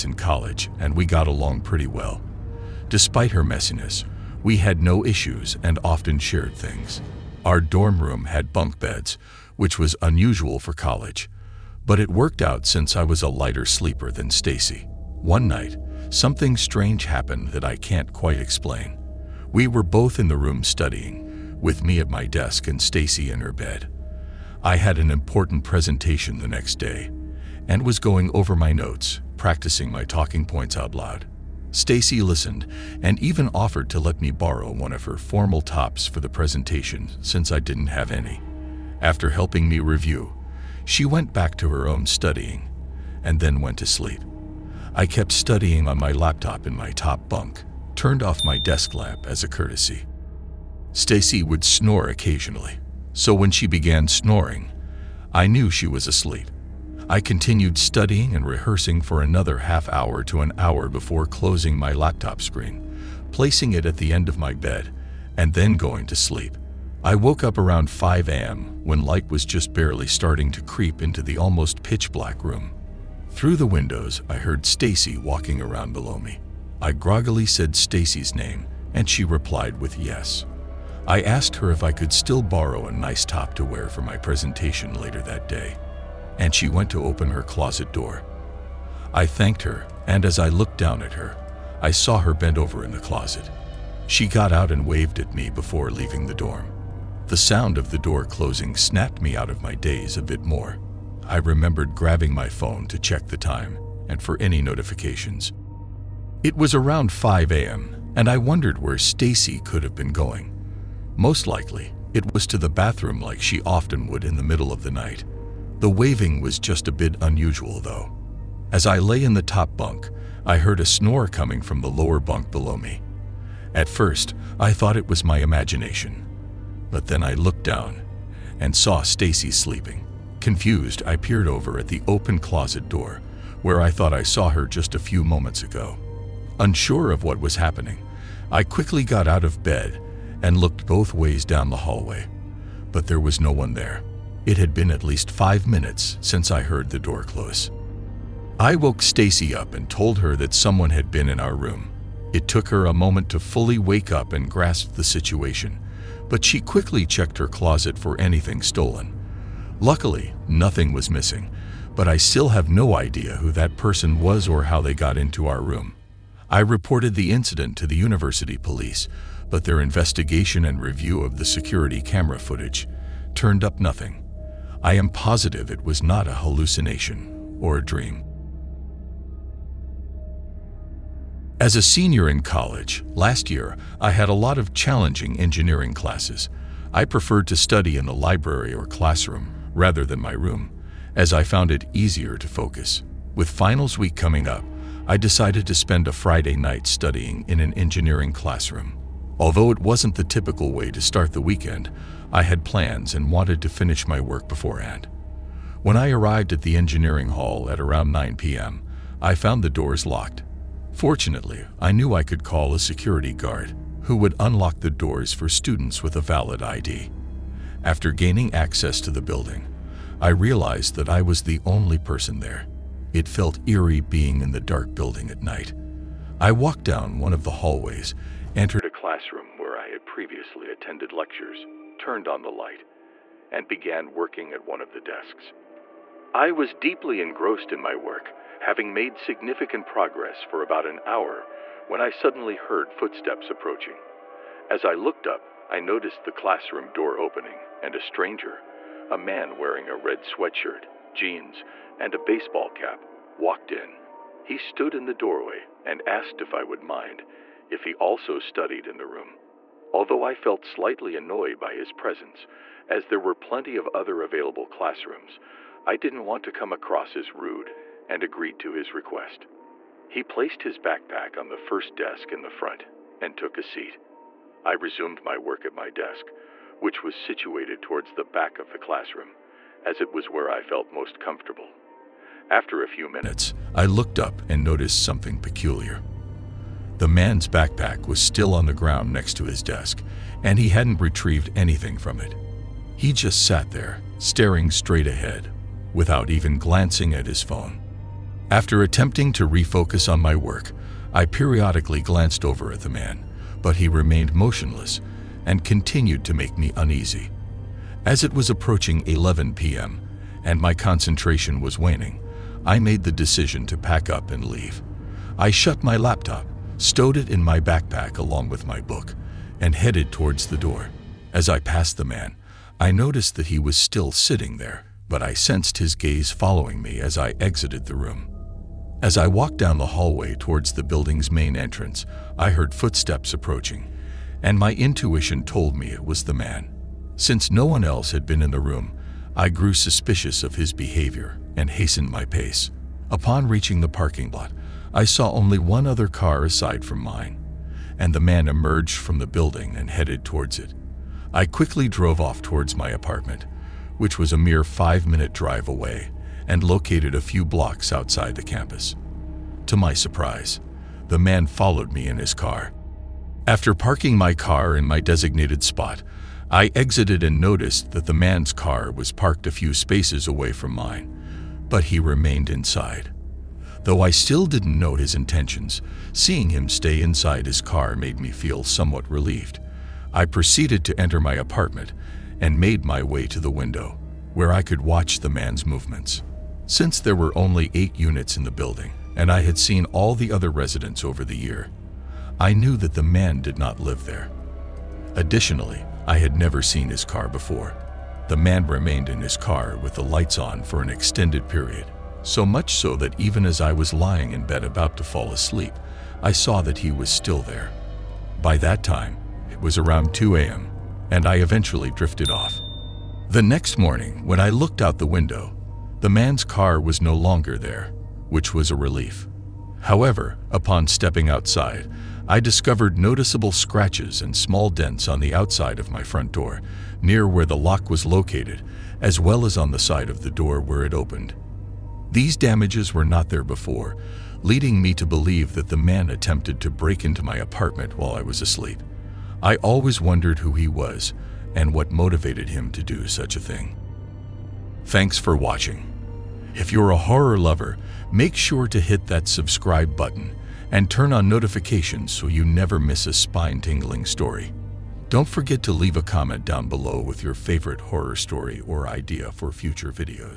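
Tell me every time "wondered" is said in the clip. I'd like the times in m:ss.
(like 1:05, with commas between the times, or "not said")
1:48, 7:19.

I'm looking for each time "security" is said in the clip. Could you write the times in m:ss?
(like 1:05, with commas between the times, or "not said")
2:51, 3:32.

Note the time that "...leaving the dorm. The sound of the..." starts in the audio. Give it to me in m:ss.
1:35.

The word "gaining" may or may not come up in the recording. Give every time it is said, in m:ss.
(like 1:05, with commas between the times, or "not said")
3:38.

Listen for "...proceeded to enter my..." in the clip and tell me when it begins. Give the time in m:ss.
6:20.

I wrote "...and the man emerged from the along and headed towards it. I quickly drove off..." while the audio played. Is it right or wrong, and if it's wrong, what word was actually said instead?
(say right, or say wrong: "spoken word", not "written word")
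wrong: "building", not "along".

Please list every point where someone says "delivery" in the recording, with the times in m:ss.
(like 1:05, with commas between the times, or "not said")
not said.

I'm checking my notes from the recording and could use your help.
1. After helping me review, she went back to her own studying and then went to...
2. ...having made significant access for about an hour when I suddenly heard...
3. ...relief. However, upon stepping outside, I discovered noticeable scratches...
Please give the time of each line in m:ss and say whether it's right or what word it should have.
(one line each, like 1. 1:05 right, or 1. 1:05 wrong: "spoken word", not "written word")
1. 0:39 right
2. 3:58 wrong: "progress", not "access"
3. 6:58 right.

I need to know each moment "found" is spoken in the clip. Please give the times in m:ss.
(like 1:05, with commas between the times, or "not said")
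3:11, 3:29.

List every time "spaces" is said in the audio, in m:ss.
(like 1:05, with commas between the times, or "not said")
6:09.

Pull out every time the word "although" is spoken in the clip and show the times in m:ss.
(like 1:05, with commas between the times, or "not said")
3:19, 4:19.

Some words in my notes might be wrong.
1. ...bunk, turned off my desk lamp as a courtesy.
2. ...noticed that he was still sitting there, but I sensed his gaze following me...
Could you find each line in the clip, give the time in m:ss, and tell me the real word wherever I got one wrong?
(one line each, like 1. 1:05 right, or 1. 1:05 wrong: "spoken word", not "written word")
1. 0:47 right
2. 5:22 right.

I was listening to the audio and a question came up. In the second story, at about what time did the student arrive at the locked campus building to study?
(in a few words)
9 p.m.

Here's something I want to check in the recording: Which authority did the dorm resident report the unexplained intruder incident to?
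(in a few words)
university police.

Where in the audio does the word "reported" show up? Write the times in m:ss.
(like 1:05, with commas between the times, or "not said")
2:46.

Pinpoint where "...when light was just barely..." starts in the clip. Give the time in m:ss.
1:08.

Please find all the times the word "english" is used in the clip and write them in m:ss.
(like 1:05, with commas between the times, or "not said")
not said.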